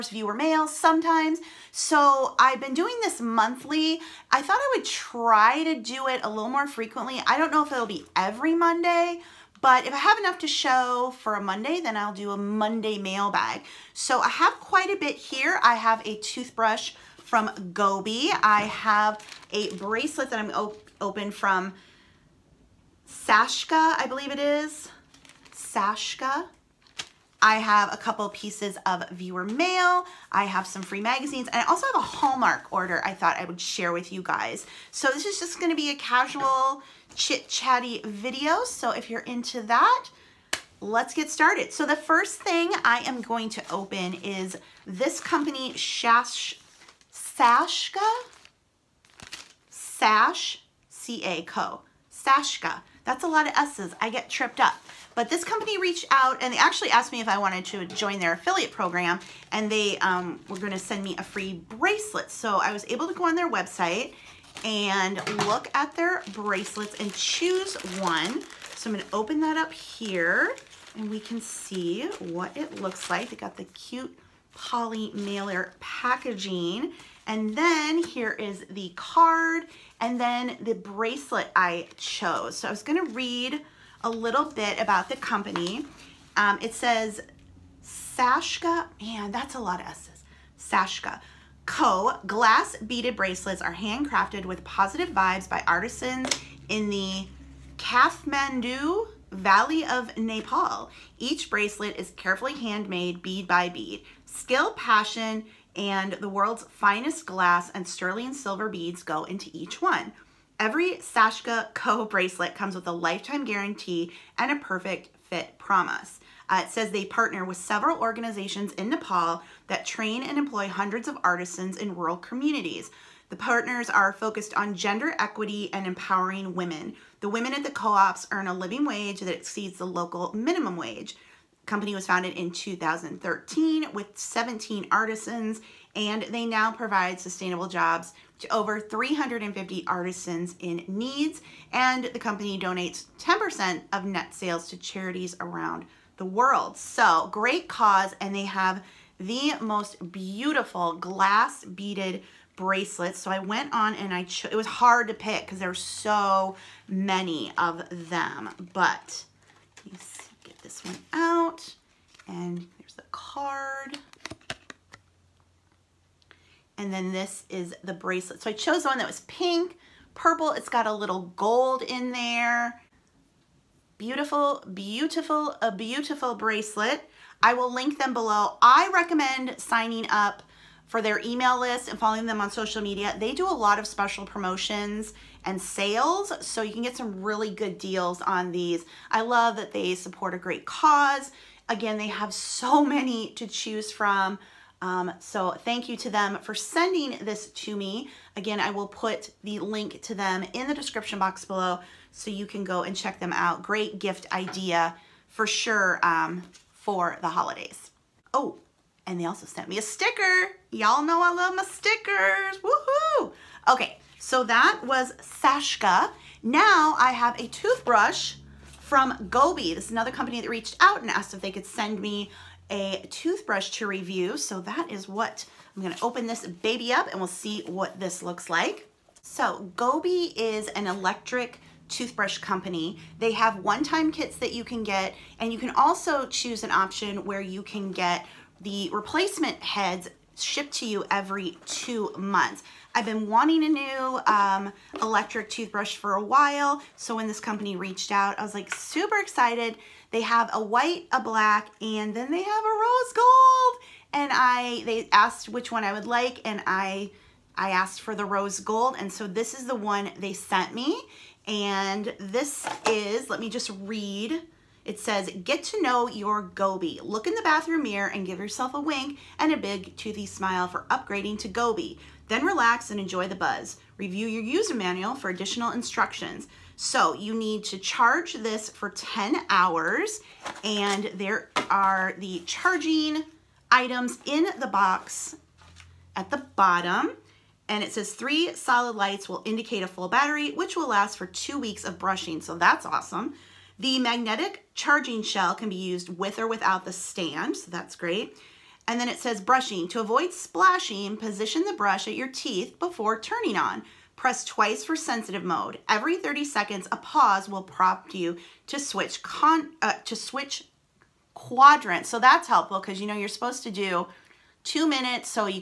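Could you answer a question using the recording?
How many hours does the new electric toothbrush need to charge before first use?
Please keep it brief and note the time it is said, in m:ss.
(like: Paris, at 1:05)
10, at 4:38.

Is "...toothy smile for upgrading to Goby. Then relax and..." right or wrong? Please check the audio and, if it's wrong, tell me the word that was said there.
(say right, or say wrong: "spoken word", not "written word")
right.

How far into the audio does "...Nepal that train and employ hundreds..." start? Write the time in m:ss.
1:58.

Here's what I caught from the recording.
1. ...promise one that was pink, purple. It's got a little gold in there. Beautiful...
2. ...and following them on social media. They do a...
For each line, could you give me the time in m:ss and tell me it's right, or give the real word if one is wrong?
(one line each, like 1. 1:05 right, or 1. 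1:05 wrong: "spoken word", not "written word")
1. 2:48 wrong: "chose", not "promise"
2. 3:01 right.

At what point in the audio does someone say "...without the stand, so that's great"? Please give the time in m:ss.
4:56.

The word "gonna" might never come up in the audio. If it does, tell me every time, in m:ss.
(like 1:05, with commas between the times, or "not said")
0:35, 1:00, 1:08, 1:22, 3:45.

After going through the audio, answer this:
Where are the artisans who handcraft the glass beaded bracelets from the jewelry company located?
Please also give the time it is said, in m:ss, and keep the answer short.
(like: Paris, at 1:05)
Kathmandu Valley, at 1:37.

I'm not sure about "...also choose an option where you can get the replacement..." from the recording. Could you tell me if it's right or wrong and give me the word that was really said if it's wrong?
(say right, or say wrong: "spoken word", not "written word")
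right.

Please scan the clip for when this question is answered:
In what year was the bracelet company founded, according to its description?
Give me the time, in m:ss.
2:12.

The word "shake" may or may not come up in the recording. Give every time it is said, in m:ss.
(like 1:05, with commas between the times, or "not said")
not said.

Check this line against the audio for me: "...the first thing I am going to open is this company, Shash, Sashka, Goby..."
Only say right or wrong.
wrong.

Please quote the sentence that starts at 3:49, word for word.
So Goby is an electric toothbrush company.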